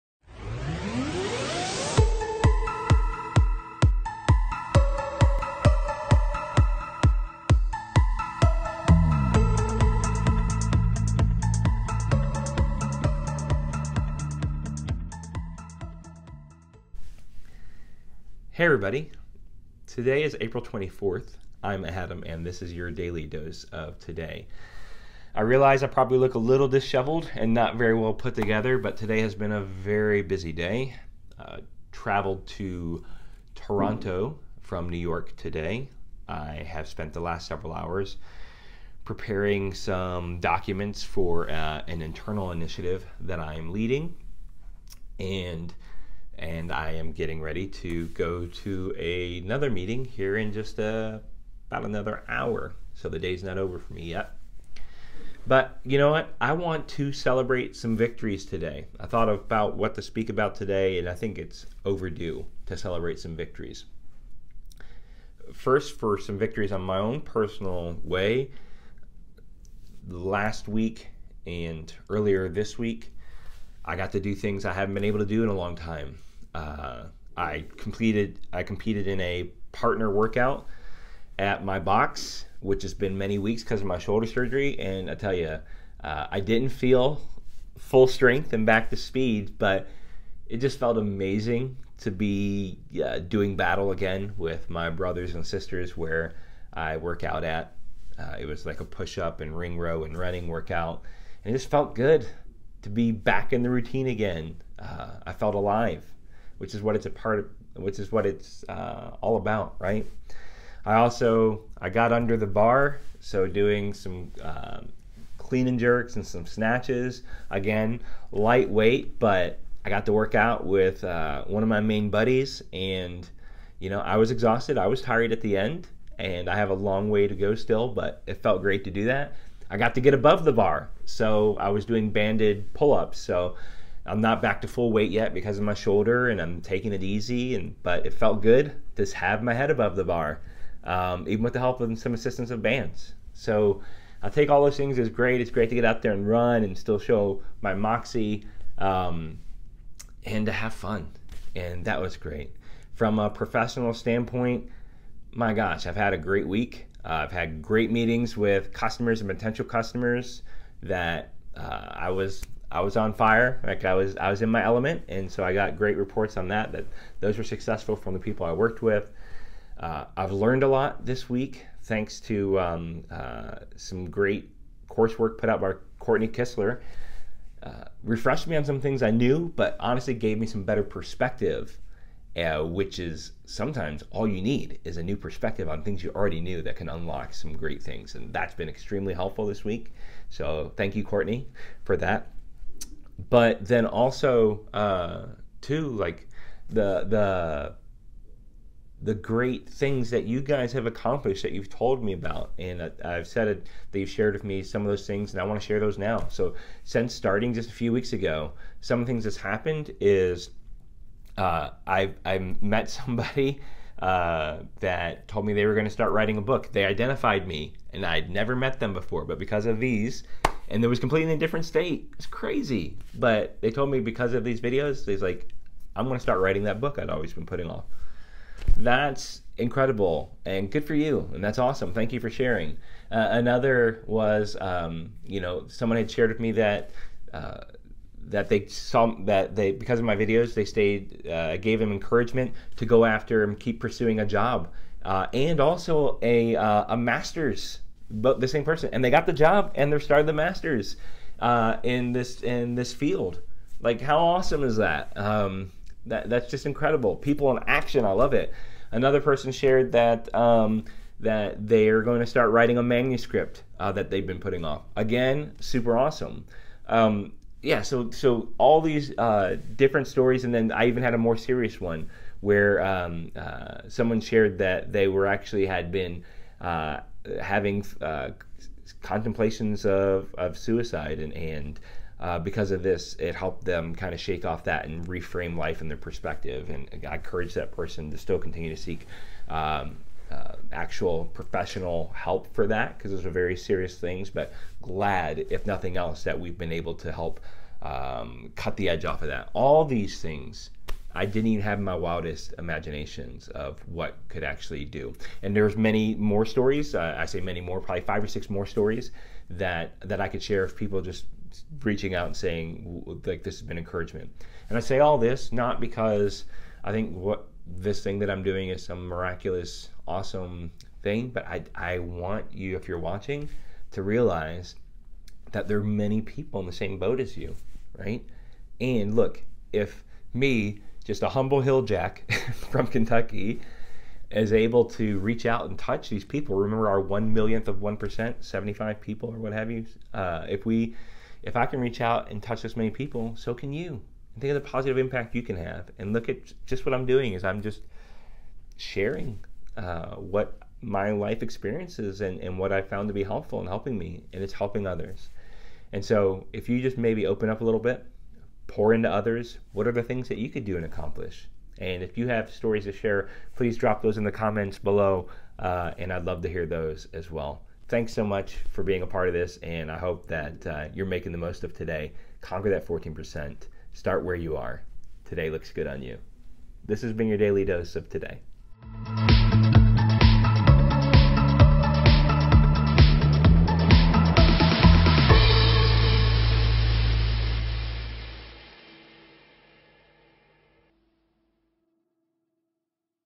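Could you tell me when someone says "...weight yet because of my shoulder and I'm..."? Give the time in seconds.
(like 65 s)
134 s.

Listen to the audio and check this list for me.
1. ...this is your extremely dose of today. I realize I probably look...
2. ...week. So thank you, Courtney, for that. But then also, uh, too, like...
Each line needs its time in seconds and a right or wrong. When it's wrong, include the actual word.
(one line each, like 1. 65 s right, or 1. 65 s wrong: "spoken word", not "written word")
1. 22 s wrong: "daily", not "extremely"
2. 189 s right.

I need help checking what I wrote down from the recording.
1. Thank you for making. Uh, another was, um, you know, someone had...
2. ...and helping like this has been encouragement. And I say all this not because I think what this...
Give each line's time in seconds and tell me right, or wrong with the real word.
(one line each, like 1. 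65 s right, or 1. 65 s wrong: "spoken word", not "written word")
1. 231 s wrong: "sharing", not "making"
2. 312 s wrong: "saying", not "helping".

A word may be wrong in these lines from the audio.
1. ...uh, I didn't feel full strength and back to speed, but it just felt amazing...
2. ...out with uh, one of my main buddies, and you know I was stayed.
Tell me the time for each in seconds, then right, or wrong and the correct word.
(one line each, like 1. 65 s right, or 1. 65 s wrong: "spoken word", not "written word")
1. 86 s right
2. 120 s wrong: "exhausted", not "stayed".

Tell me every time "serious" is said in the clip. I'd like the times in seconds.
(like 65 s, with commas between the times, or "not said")
271 s, 293 s.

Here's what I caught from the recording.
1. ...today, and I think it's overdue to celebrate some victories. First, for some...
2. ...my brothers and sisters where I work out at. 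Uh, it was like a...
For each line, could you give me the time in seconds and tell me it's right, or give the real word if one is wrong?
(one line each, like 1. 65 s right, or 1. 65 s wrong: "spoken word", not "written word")
1. 60 s right
2. 94 s right.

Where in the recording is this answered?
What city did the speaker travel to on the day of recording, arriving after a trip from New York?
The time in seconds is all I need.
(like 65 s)
33 s.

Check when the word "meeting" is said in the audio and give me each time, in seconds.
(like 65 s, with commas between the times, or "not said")
49 s, 157 s.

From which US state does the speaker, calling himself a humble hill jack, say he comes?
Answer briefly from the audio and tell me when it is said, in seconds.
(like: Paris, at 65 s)
Kentucky, at 332 s.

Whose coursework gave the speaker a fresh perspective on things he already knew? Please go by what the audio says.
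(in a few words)
Courtney Kistler.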